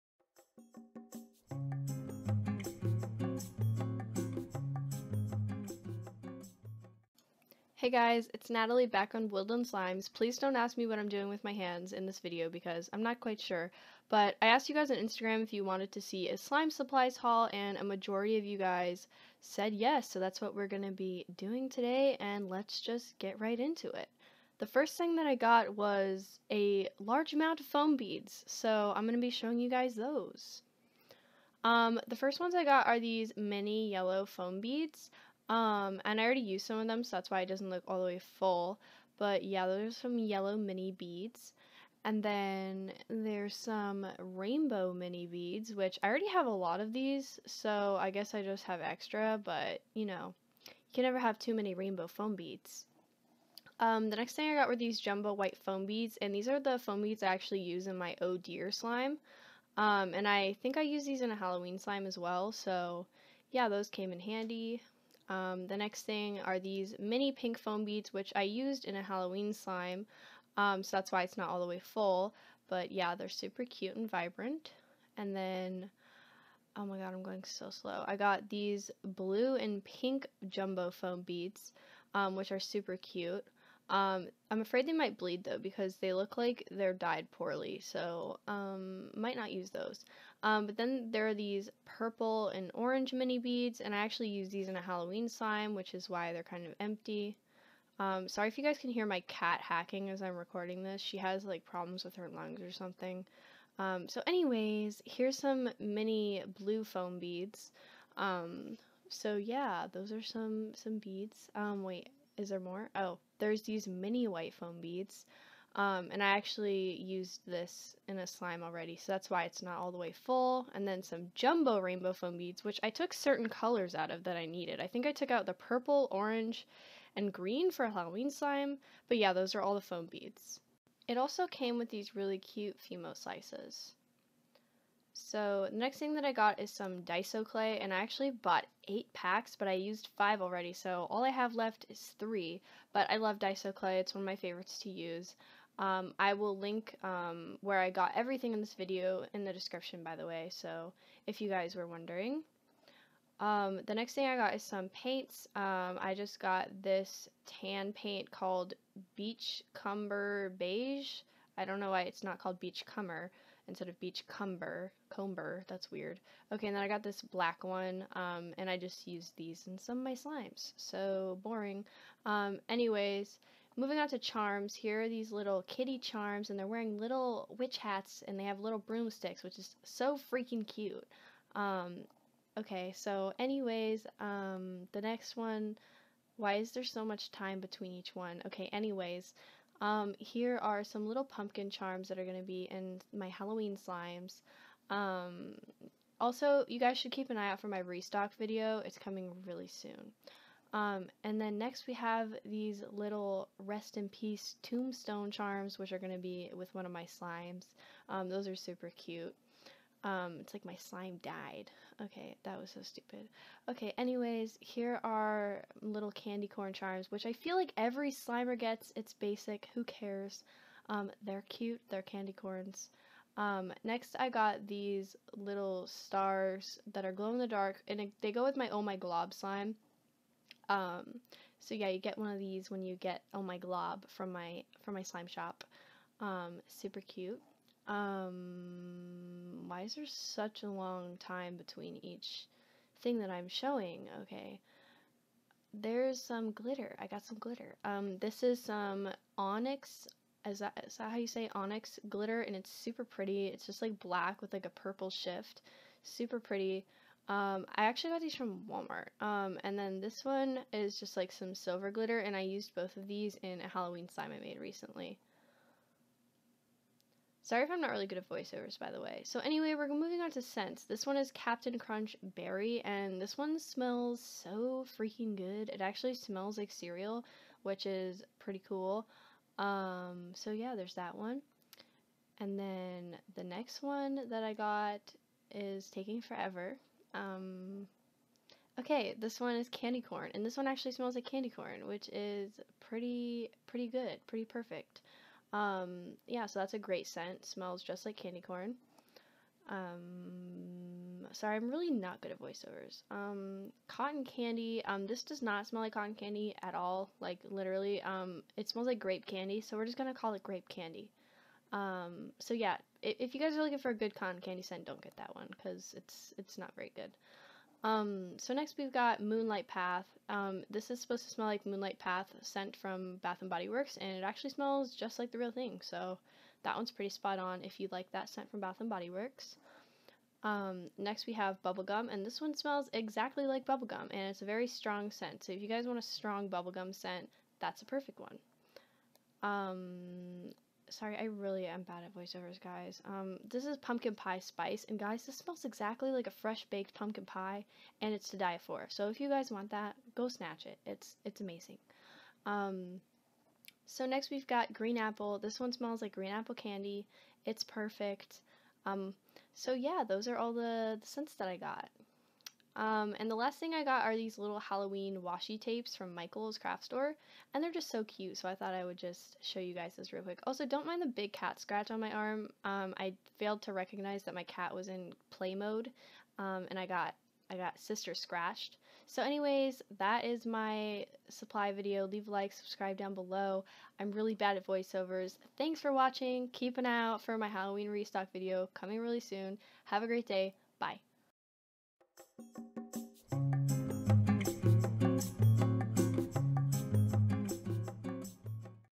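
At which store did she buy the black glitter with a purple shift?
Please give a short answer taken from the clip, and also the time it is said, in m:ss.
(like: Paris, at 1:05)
Walmart, at 4:18.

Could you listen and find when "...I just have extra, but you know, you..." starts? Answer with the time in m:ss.
0:48.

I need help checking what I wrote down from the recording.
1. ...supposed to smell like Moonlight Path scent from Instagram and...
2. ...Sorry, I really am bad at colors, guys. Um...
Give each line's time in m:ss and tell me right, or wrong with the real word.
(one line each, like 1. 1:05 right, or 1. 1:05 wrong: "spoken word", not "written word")
1. 5:21 wrong: "Bath", not "Instagram"
2. 5:40 wrong: "voiceovers", not "colors".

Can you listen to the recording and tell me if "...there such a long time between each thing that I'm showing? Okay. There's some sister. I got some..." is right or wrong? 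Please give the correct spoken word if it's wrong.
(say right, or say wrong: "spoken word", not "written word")
wrong: "glitter", not "sister".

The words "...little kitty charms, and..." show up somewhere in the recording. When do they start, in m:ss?
2:55.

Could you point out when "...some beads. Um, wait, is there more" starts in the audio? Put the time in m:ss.
1:50.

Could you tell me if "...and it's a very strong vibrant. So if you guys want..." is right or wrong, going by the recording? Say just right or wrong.
wrong.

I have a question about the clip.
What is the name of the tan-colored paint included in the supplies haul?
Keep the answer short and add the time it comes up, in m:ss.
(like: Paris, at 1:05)
Beach Cumber Beige, at 2:39.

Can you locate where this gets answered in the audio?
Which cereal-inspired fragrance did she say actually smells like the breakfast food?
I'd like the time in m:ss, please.
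4:31.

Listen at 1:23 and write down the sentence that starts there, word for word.
Um, I'm afraid they might bleed though because they look like they're dyed poorly, so um, might not use those.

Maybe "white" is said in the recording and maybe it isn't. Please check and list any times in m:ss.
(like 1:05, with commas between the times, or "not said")
0:55, 1:54.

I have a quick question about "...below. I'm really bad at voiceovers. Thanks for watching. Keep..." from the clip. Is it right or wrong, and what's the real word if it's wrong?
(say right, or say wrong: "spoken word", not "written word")
right.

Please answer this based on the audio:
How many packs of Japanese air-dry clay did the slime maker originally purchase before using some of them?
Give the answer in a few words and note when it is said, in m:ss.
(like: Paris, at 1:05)
8, at 2:18.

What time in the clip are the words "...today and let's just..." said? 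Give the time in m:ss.
0:21.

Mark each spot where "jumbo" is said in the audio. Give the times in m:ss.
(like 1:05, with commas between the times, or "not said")
0:55, 1:20, 2:01.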